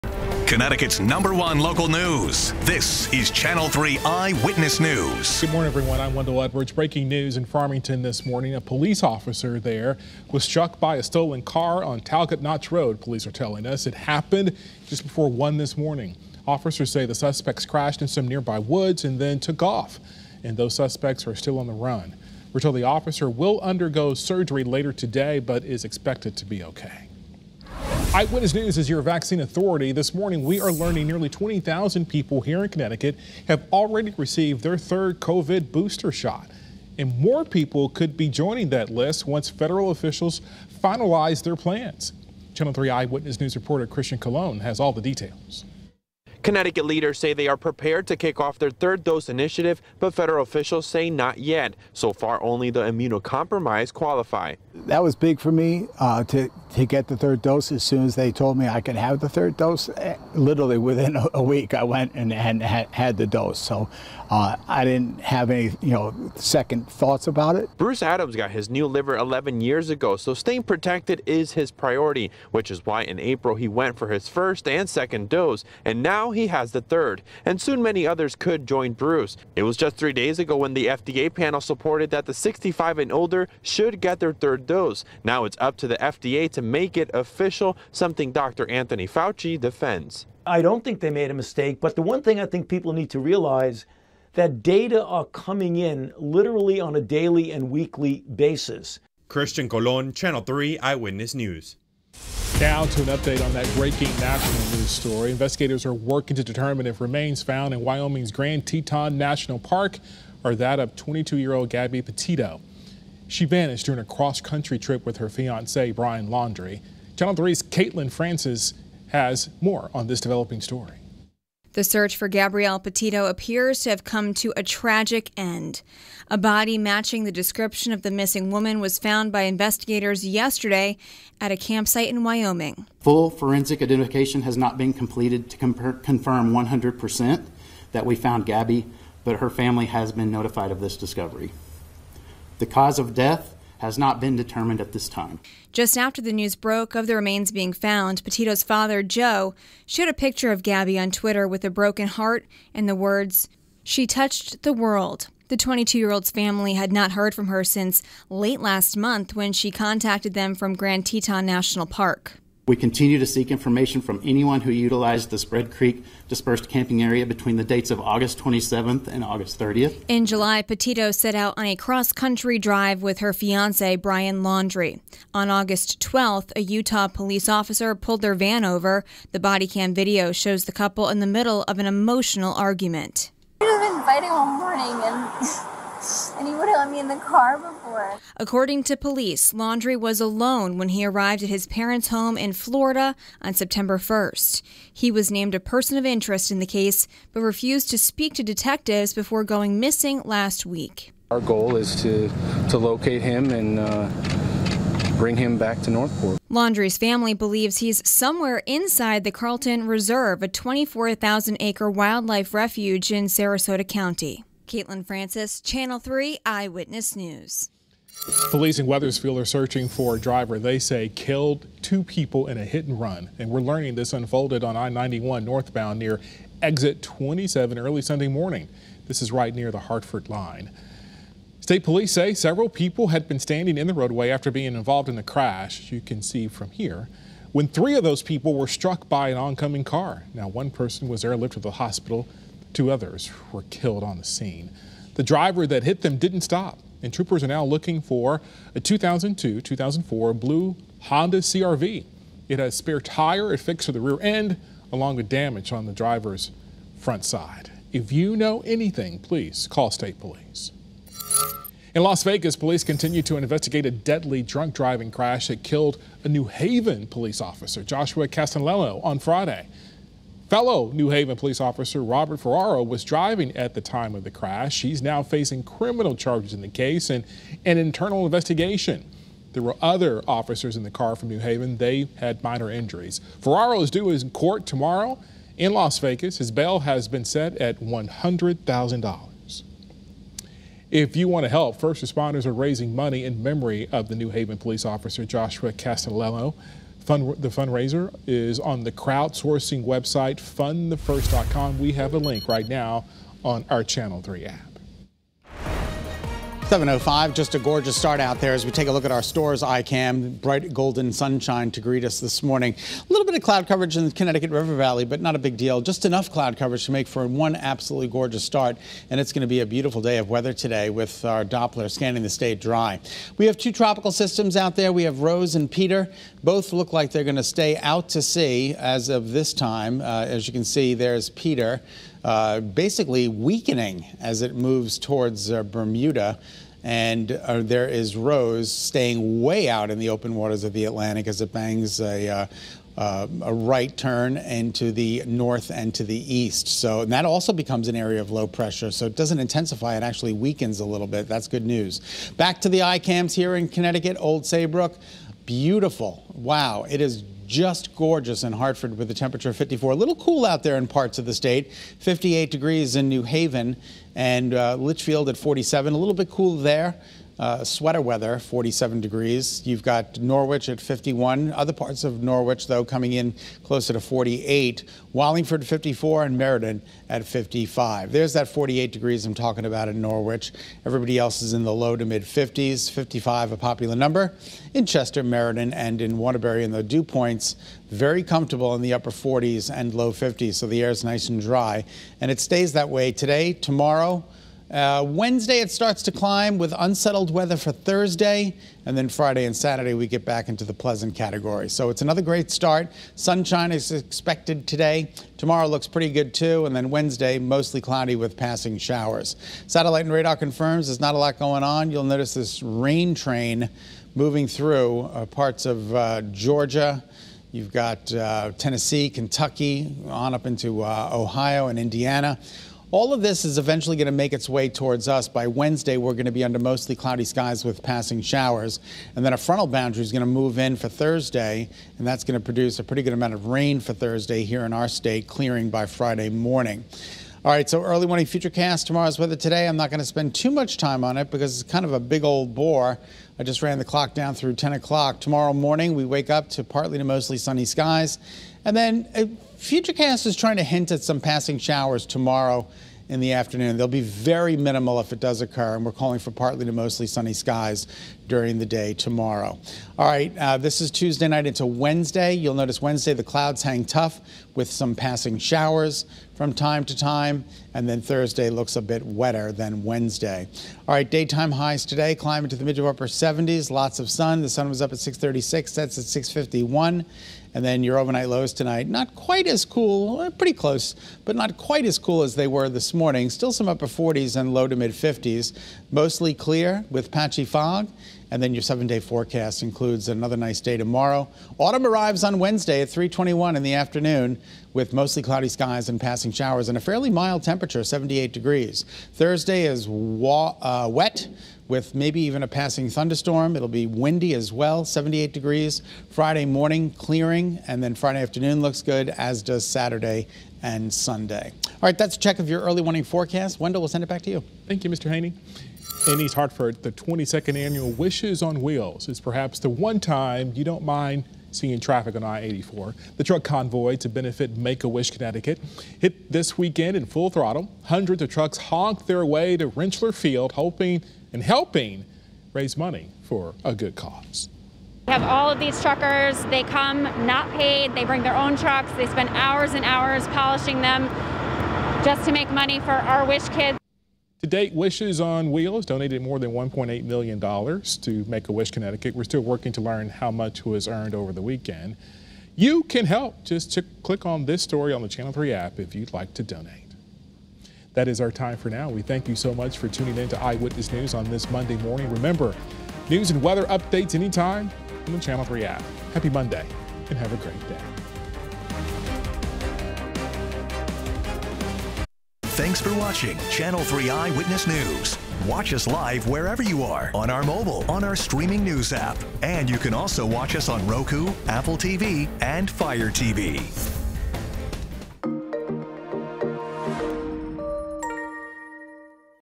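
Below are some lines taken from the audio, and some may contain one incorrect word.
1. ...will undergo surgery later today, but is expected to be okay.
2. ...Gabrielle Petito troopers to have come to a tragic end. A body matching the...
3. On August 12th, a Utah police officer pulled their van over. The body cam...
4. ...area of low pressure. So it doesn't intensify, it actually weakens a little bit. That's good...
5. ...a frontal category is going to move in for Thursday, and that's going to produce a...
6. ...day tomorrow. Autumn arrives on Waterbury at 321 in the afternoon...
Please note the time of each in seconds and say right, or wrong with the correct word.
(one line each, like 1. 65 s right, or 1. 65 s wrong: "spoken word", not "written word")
1. 23 s right
2. 122 s wrong: "appears", not "troopers"
3. 175 s right
4. 347 s right
5. 429 s wrong: "boundary", not "category"
6. 490 s wrong: "Wednesday", not "Waterbury".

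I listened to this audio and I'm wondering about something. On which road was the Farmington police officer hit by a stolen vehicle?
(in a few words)
Talcott Notch Road.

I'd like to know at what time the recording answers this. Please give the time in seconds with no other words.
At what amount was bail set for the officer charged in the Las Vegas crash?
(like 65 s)
287 s.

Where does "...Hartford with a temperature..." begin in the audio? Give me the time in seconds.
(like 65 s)
358 s.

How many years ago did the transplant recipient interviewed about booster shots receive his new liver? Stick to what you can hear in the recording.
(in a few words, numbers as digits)
11.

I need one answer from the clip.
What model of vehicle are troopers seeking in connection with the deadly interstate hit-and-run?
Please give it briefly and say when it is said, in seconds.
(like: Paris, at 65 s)
Honda CRV, at 251 s.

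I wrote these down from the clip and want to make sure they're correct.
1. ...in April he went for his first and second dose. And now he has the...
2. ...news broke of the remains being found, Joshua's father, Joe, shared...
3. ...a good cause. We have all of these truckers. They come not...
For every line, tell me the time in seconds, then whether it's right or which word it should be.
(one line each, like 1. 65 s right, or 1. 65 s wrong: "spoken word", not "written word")
1. 73 s right
2. 146 s wrong: "Petito", not "Joshua"
3. 533 s right.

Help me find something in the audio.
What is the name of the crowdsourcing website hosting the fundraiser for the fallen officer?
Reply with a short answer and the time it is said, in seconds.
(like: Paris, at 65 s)
fundthefirst.com, at 300 s.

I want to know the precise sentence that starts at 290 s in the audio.
If you want to help, first responders are raising money in memory of the New Haven police officer Joshua Castellano.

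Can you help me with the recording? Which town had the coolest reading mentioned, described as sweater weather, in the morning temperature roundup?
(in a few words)
Litchfield.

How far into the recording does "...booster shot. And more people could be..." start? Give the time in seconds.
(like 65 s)
35 s.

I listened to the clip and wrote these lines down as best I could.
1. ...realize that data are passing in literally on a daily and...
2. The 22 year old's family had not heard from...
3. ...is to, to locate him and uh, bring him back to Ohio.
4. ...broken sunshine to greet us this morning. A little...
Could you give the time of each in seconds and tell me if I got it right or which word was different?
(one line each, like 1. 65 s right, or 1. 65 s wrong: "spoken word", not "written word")
1. 93 s wrong: "coming", not "passing"
2. 155 s right
3. 201 s wrong: "Northport", not "Ohio"
4. 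310 s wrong: "golden", not "broken".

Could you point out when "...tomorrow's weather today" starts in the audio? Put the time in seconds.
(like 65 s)
438 s.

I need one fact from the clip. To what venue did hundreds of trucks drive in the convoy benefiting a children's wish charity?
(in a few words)
Rentschler Field.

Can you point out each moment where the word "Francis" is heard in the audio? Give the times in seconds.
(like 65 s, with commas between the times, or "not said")
118 s, 215 s.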